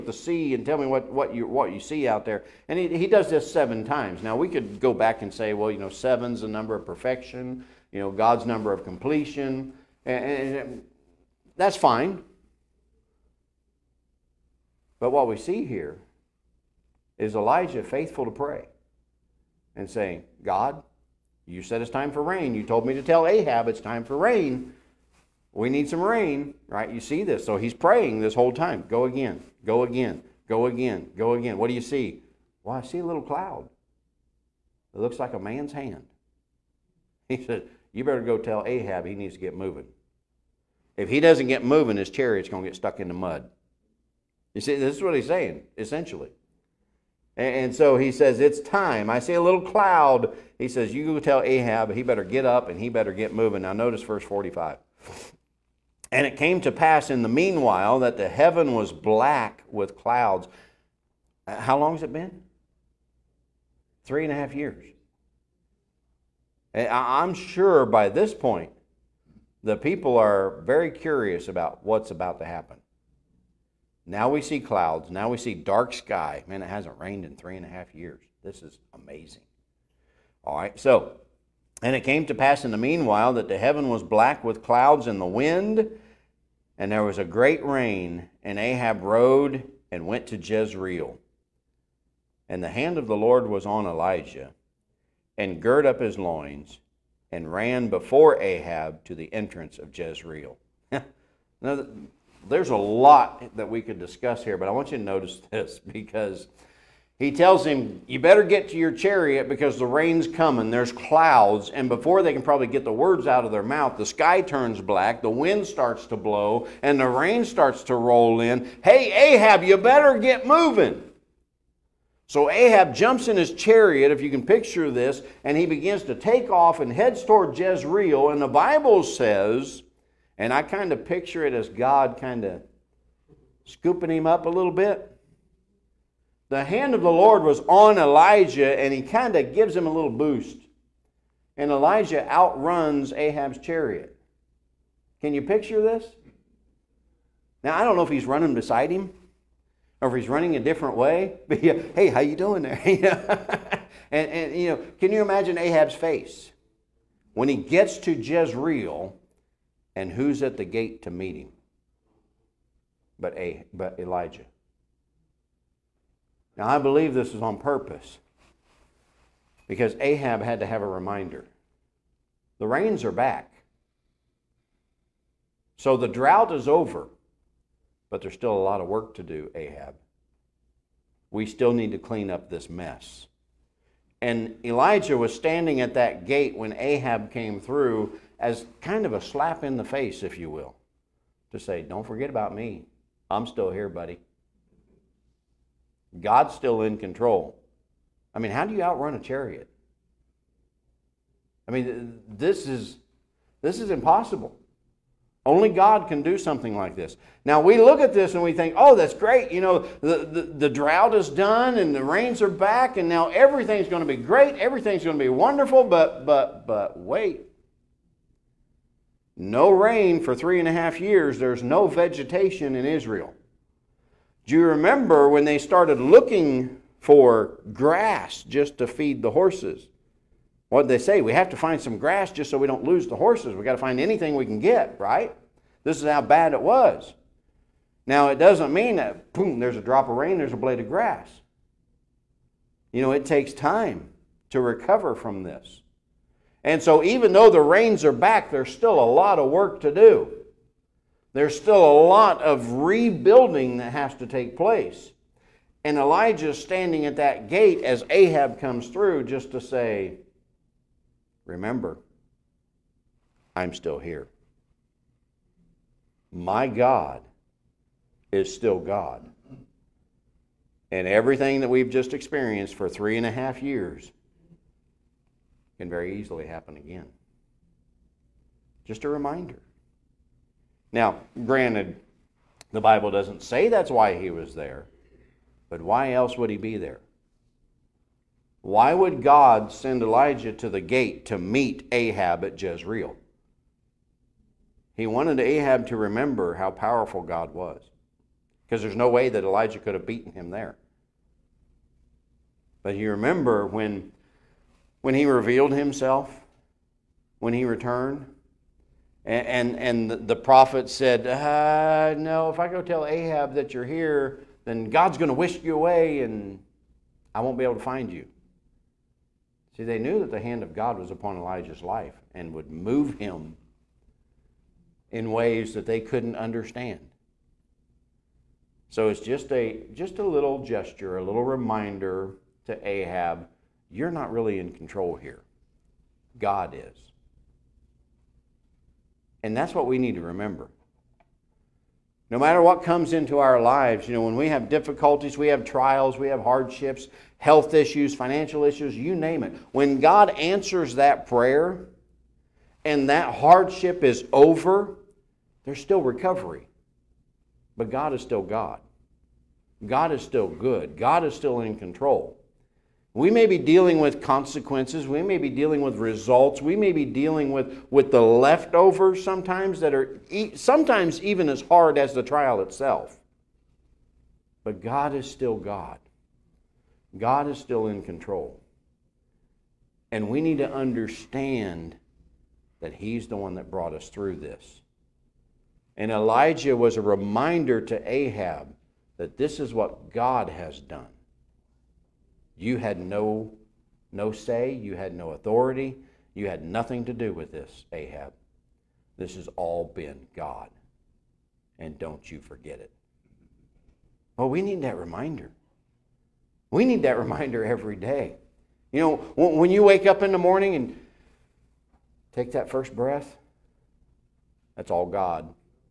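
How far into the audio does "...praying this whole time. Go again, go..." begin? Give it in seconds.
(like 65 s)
27 s.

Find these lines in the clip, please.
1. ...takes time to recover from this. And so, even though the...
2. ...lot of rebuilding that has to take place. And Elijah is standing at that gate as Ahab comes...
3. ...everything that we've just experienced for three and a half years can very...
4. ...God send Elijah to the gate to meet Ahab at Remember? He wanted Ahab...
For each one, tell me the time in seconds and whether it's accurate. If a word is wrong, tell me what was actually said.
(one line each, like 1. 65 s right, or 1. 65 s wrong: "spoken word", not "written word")
1. 243 s right
2. 252 s right
3. 271 s right
4. 289 s wrong: "Jezreel", not "Remember".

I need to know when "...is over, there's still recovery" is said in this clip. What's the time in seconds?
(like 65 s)
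354 s.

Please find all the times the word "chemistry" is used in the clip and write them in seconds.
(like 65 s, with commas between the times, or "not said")
not said.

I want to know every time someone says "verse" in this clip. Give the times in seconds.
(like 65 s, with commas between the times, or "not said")
54 s.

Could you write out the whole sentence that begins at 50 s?
He says, You go tell Ahab he better get up and he better get moving.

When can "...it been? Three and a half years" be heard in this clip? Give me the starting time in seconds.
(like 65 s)
62 s.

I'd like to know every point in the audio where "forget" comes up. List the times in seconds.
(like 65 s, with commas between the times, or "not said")
192 s, 402 s.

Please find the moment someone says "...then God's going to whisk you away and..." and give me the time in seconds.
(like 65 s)
314 s.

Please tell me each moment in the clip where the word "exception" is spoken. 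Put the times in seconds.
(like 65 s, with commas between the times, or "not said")
not said.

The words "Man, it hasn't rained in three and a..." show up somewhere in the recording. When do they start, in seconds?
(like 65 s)
76 s.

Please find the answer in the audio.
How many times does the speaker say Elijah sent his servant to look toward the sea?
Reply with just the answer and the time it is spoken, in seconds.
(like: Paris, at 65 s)
7, at 3 s.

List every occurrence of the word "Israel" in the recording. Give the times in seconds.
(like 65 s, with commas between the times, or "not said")
222 s.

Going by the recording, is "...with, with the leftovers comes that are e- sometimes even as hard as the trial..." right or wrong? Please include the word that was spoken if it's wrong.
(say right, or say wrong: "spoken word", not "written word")
wrong: "sometimes", not "comes".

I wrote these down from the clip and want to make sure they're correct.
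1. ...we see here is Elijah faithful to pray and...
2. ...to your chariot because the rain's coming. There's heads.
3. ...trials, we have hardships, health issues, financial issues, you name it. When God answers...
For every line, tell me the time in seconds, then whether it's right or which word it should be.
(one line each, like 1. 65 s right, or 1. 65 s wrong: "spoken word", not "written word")
1. 15 s right
2. 108 s wrong: "clouds", not "heads"
3. 345 s right.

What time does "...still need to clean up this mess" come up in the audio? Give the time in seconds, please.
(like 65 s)
181 s.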